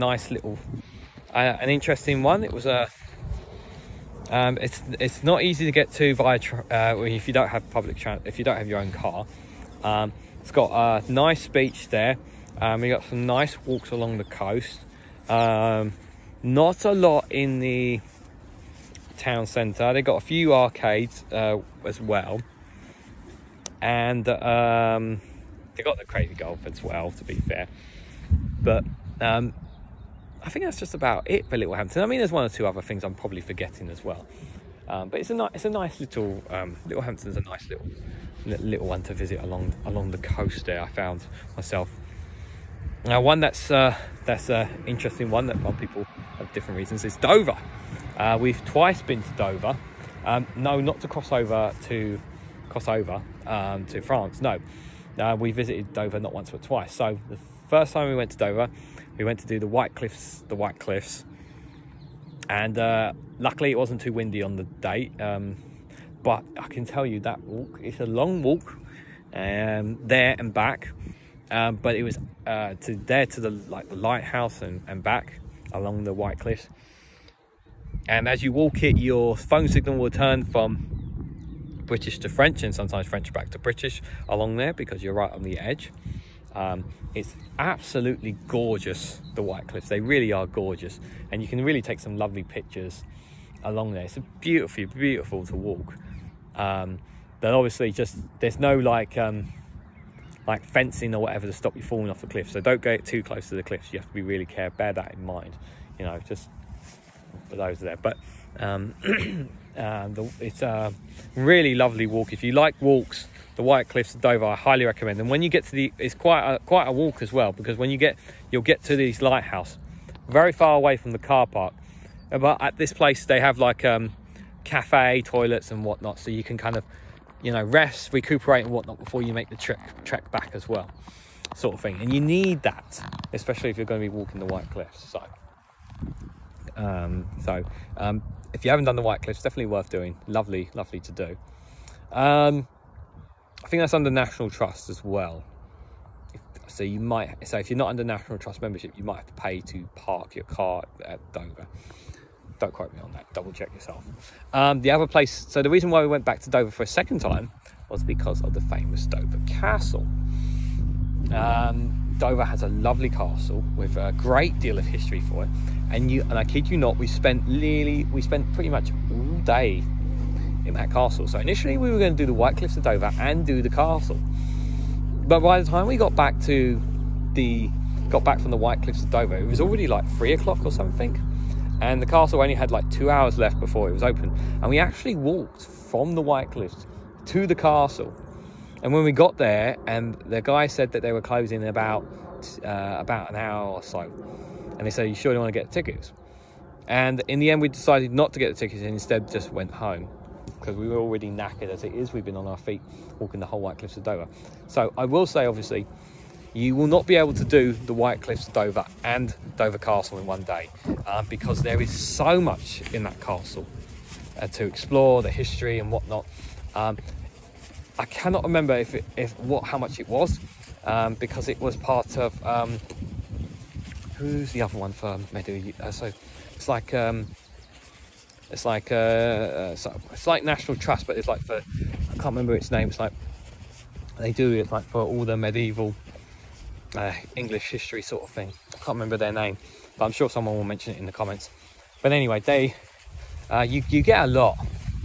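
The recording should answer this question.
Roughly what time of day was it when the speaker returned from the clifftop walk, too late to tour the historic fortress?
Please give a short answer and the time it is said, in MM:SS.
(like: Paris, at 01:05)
3 o'clock, at 03:00.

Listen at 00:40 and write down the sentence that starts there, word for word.
There, I found myself now, one that's uh, that's an uh, interesting one that people have different reasons is Dover.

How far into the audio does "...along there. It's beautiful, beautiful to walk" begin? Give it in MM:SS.
01:33.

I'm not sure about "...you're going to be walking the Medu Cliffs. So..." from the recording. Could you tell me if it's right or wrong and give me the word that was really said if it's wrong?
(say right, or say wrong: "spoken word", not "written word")
wrong: "White", not "Medu".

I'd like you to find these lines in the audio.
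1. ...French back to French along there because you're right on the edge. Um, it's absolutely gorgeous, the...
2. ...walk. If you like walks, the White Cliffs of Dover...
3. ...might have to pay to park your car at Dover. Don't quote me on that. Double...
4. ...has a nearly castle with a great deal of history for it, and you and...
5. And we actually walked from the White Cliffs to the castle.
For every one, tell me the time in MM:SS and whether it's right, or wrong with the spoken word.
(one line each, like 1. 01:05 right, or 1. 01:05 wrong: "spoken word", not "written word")
1. 01:23 wrong: "British", not "French"
2. 01:52 right
3. 02:29 right
4. 02:42 wrong: "lovely", not "nearly"
5. 03:04 right.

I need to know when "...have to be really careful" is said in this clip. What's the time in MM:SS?
01:43.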